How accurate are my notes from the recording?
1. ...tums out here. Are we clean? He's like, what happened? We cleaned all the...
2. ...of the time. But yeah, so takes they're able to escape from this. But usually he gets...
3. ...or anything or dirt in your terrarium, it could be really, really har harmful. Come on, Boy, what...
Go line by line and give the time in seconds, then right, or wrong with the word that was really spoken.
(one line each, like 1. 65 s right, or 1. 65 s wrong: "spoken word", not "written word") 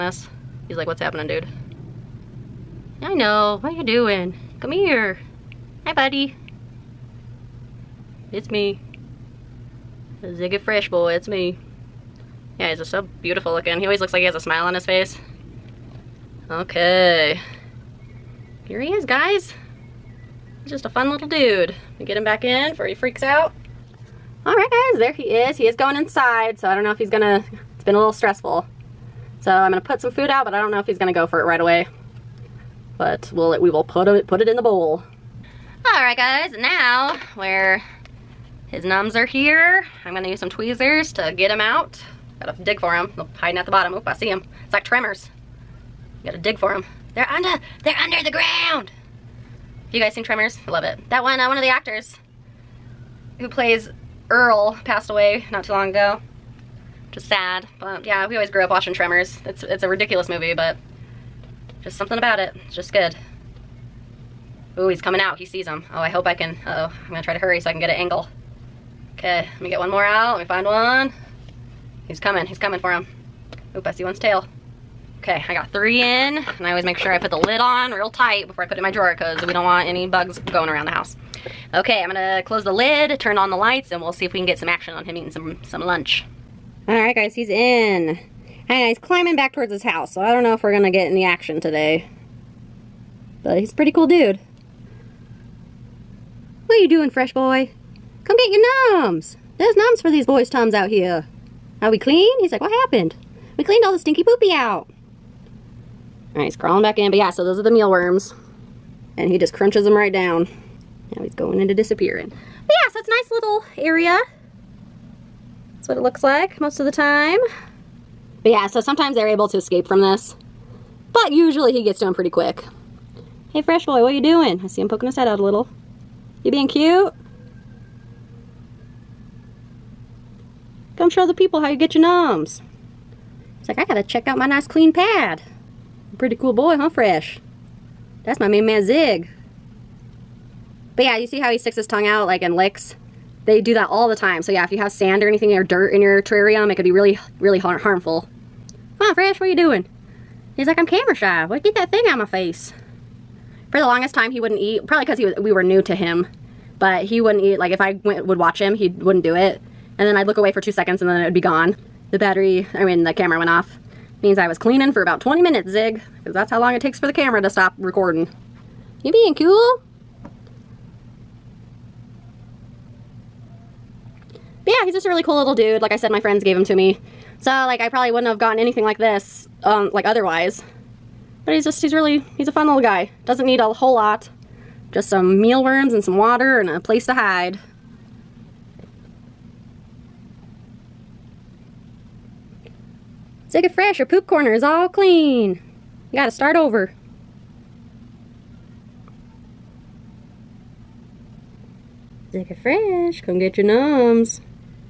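1. 100 s right
2. 116 s wrong: "sometimes", not "takes"
3. 145 s wrong: "Fresh", not "Boy".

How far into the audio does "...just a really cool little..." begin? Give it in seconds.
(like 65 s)
174 s.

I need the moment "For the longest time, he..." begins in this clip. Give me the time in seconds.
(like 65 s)
153 s.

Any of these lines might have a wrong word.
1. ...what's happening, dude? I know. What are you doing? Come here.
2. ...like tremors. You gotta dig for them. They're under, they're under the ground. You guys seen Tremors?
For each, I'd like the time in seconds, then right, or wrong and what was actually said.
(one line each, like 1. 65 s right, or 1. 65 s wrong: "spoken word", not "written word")
1. 0 s right
2. 44 s right.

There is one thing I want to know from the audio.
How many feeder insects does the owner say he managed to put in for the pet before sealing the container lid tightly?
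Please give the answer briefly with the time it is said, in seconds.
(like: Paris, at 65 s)
3, at 75 s.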